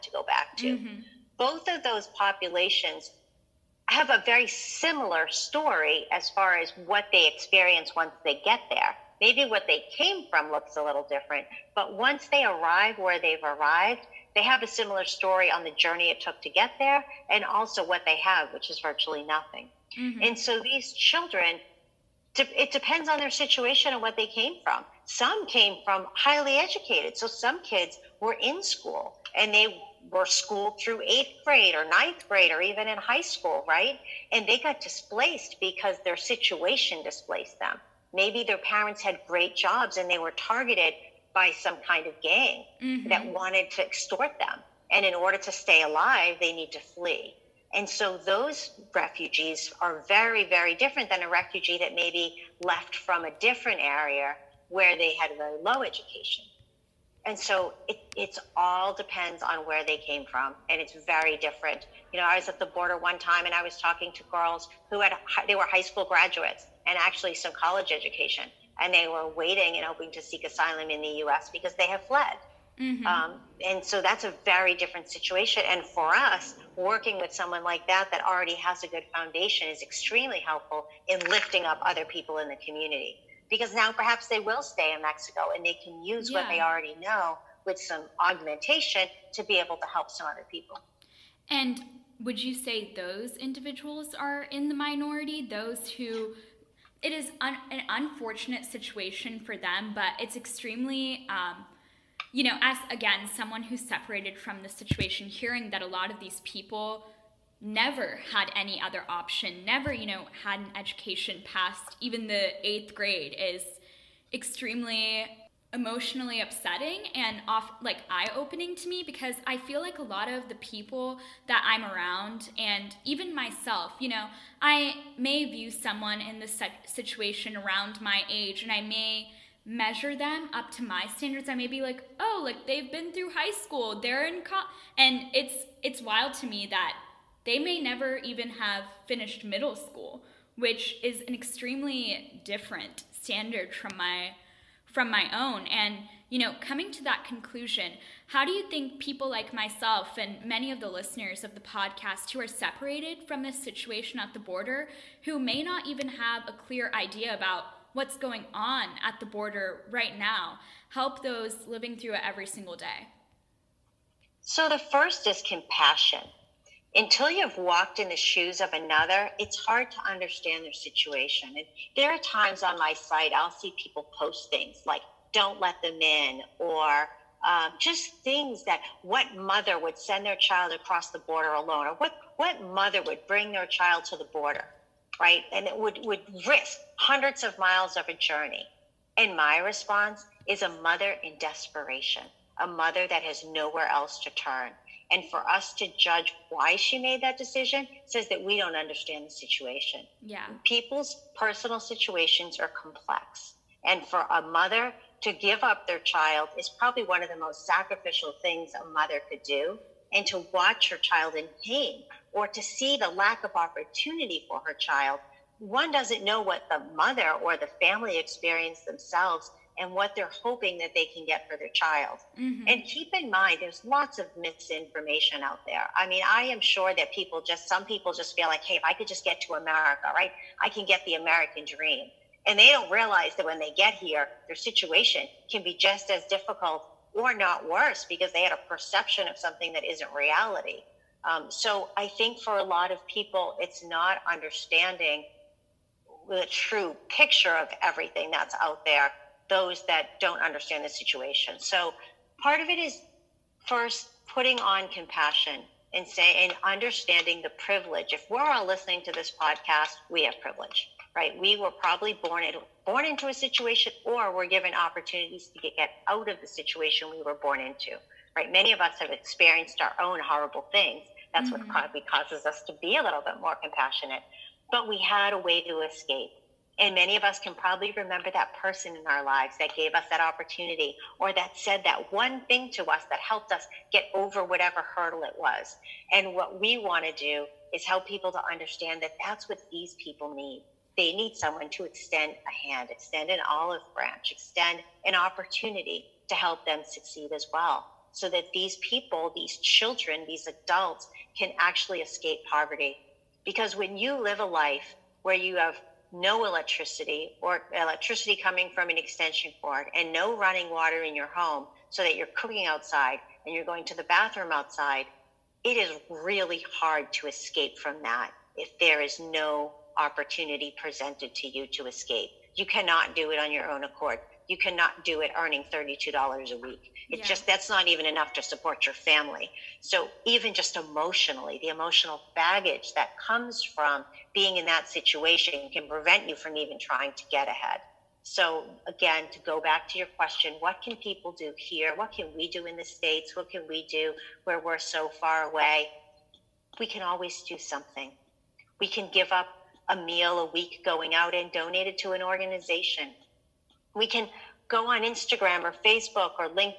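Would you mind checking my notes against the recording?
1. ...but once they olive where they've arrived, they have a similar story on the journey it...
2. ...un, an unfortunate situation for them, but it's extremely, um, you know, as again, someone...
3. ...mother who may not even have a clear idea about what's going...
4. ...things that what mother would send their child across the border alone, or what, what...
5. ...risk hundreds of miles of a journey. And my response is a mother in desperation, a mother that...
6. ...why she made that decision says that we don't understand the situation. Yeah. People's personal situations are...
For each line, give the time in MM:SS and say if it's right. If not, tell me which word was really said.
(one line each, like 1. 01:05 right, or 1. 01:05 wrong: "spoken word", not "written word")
1. 00:11 wrong: "arrive", not "olive"
2. 01:37 right
3. 02:34 wrong: "border", not "mother"
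4. 02:58 right
5. 03:06 right
6. 03:16 right.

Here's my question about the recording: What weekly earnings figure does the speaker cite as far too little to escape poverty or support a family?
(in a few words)
$32.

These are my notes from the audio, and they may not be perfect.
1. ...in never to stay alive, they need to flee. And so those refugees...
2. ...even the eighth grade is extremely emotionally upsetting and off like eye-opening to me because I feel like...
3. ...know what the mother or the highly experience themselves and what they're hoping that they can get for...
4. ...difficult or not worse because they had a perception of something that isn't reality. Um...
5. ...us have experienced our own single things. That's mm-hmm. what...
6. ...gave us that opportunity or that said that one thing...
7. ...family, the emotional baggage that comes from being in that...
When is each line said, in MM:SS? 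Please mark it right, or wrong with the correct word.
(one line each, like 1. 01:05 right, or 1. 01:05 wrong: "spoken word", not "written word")
1. 00:45 wrong: "order", not "never"
2. 01:52 right
3. 03:36 wrong: "family", not "highly"
4. 03:56 right
5. 04:28 wrong: "horrible", not "single"
6. 04:39 right
7. 05:30 wrong: "emotionally", not "family".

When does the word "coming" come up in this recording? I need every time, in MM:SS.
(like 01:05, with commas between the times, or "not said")
02:26, 05:08.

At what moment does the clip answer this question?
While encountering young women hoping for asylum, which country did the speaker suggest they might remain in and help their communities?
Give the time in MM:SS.
01:25.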